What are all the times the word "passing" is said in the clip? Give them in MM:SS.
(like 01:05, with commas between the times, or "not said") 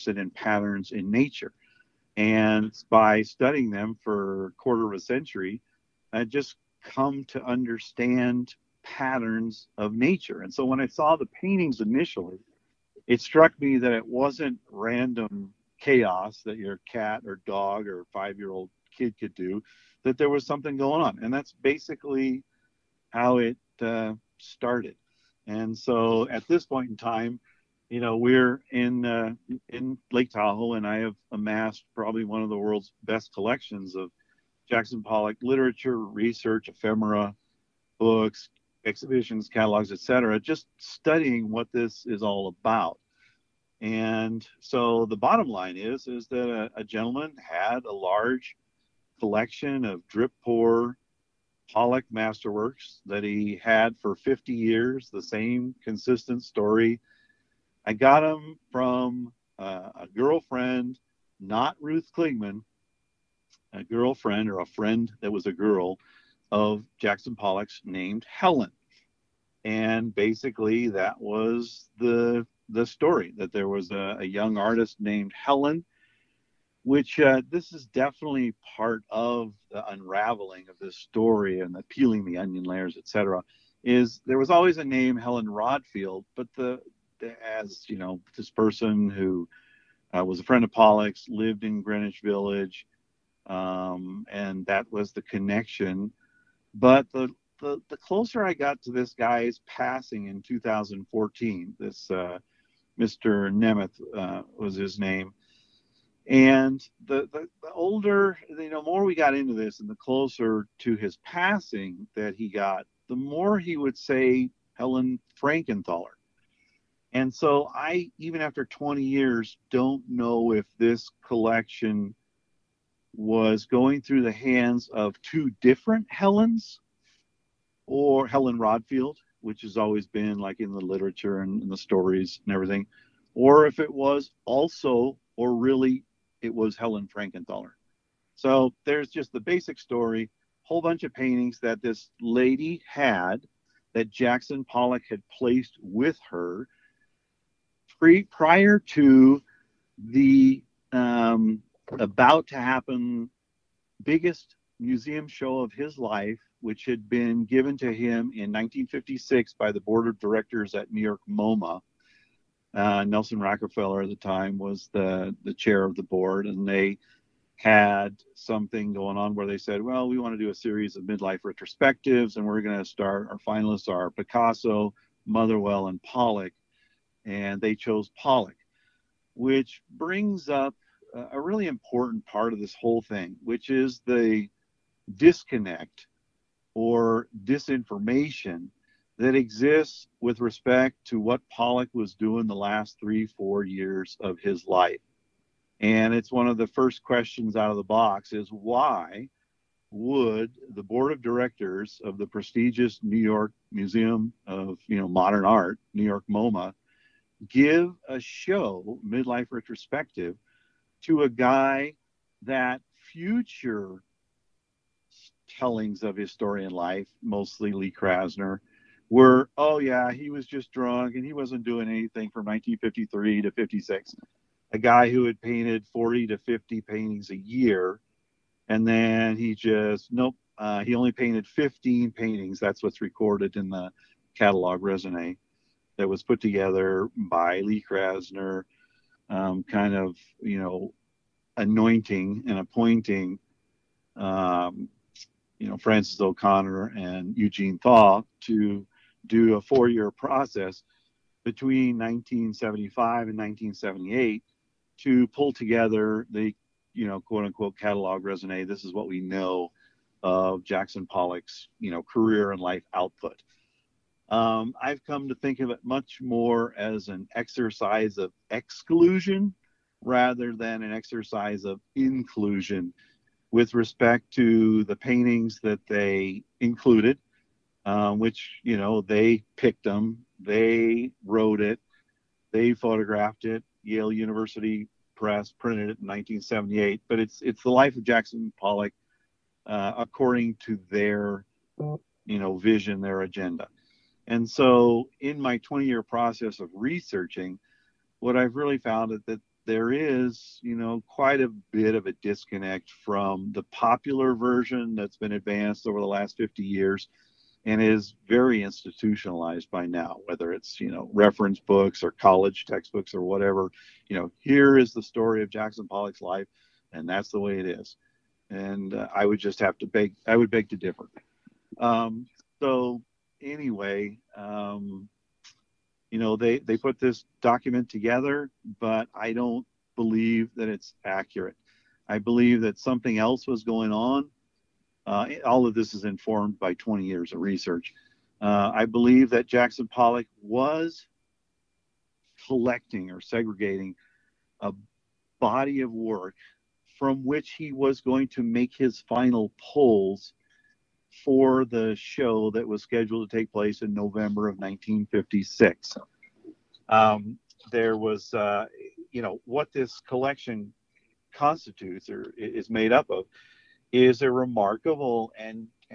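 01:39, 01:51.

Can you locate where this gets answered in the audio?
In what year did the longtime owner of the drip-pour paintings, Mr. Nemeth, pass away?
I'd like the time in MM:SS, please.
01:40.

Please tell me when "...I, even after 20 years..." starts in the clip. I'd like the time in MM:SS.
01:57.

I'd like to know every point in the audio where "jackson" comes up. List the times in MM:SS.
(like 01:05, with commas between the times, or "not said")
00:34, 01:06, 02:24, 04:20, 04:48, 05:15, 05:39.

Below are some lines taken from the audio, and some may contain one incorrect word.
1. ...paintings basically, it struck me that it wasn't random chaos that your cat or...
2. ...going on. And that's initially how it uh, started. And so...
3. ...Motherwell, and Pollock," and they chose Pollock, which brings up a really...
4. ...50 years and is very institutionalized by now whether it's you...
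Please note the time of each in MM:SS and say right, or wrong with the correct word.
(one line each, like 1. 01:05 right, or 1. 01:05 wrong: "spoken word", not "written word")
1. 00:11 wrong: "initially", not "basically"
2. 00:20 wrong: "basically", not "initially"
3. 02:55 right
4. 05:06 right.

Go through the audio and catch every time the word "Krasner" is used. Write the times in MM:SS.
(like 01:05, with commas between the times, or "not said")
03:37, 03:57.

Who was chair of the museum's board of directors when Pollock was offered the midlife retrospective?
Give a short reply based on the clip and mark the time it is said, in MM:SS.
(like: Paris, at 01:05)
Nelson Rockefeller, at 02:43.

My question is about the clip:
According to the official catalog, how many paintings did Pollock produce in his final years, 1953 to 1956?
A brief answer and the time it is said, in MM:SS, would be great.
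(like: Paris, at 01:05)
15, at 03:51.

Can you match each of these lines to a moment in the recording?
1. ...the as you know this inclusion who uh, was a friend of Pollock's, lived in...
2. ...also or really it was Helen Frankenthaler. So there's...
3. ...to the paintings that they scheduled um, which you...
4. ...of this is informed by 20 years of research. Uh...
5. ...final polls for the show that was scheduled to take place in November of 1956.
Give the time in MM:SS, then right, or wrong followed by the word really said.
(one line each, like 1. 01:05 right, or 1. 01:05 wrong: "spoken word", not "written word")
1. 01:27 wrong: "person", not "inclusion"
2. 02:14 right
3. 04:34 wrong: "included", not "scheduled"
4. 05:35 right
5. 05:49 right.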